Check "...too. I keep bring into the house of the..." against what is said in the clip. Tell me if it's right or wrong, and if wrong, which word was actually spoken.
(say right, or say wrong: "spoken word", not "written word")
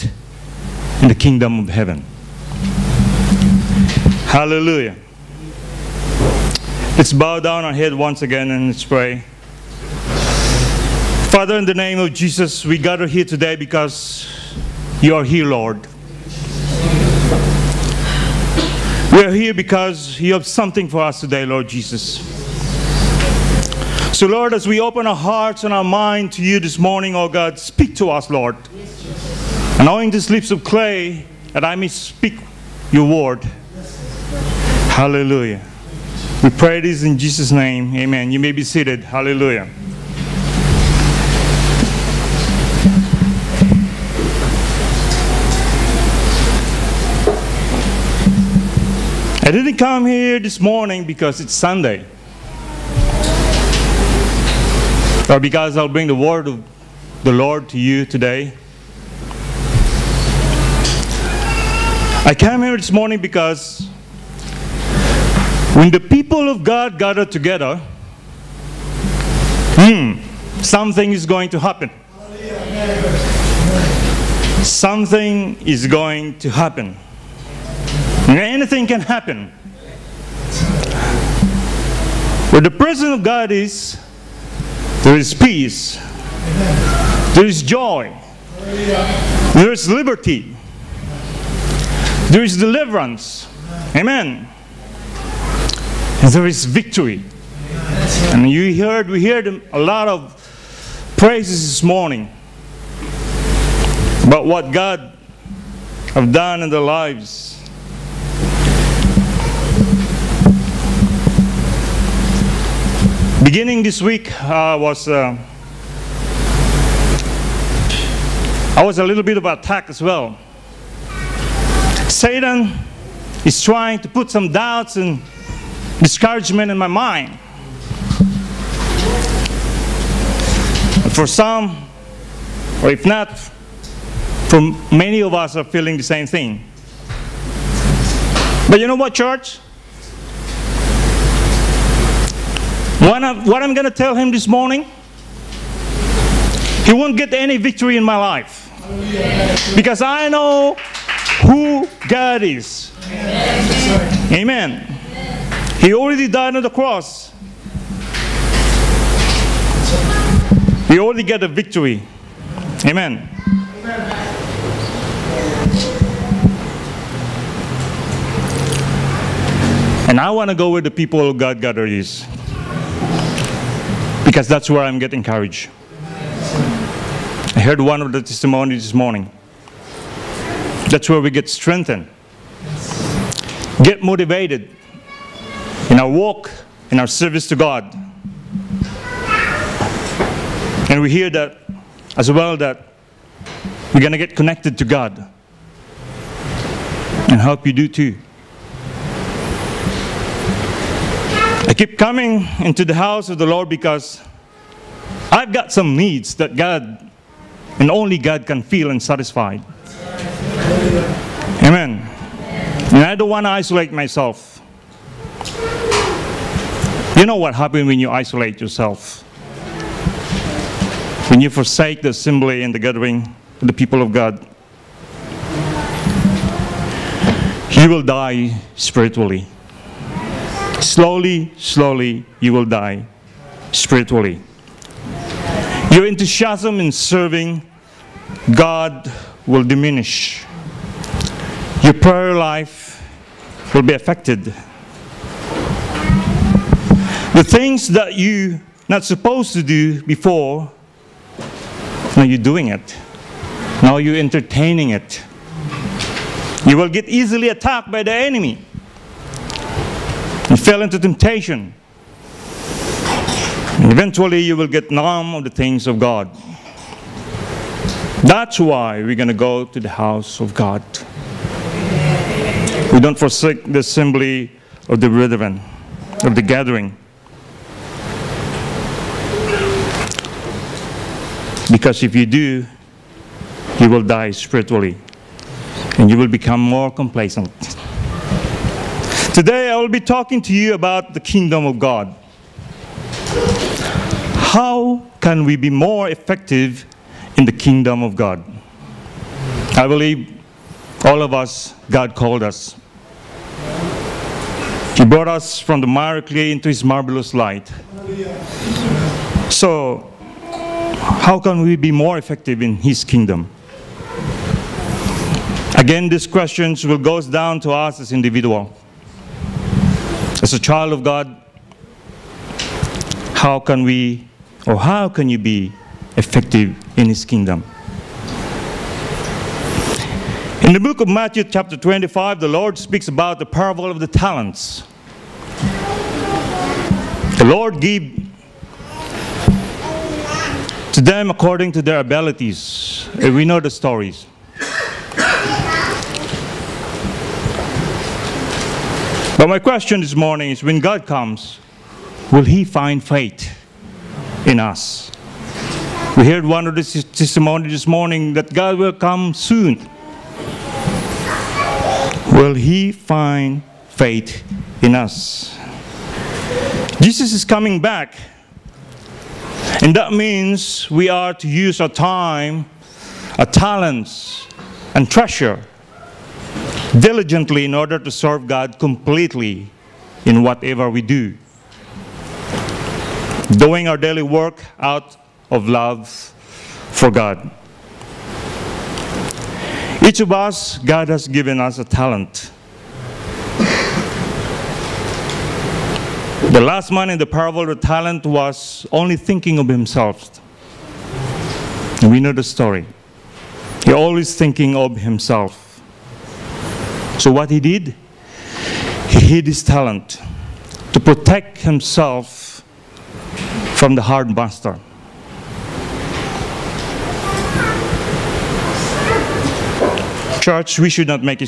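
wrong: "coming", not "bring".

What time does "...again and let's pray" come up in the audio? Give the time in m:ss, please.
0:08.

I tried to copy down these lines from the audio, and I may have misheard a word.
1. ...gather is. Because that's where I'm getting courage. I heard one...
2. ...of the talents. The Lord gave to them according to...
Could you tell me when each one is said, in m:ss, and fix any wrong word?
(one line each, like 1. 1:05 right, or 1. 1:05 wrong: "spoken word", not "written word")
1. 2:51 right
2. 5:33 right.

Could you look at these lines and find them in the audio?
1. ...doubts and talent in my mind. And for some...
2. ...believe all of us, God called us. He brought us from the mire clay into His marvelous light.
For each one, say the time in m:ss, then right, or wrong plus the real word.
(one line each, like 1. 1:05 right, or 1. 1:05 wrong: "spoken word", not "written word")
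1. 2:04 wrong: "discouragement", not "talent"
2. 4:59 right.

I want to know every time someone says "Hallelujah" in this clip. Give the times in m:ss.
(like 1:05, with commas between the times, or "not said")
0:04, 0:34, 0:39.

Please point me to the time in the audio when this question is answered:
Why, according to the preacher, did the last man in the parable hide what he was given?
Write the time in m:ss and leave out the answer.
6:50.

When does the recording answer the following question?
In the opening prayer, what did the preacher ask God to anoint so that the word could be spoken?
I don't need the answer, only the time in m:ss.
0:30.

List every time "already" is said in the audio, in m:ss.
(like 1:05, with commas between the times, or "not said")
2:35, 2:40.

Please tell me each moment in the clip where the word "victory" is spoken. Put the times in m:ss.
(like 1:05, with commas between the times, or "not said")
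1:36, 2:27, 2:41.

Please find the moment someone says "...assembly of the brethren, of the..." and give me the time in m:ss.
4:33.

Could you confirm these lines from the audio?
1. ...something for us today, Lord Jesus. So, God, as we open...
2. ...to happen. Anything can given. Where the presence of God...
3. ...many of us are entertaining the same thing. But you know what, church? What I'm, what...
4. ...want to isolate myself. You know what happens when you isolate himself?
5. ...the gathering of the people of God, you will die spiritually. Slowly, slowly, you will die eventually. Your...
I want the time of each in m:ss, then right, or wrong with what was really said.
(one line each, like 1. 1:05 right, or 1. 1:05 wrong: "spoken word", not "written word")
1. 0:20 wrong: "Lord", not "God"
2. 1:16 wrong: "happen", not "given"
3. 2:14 wrong: "feeling", not "entertaining"
4. 3:33 wrong: "yourself", not "himself"
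5. 3:42 wrong: "spiritually", not "eventually".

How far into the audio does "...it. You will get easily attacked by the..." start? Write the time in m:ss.
4:14.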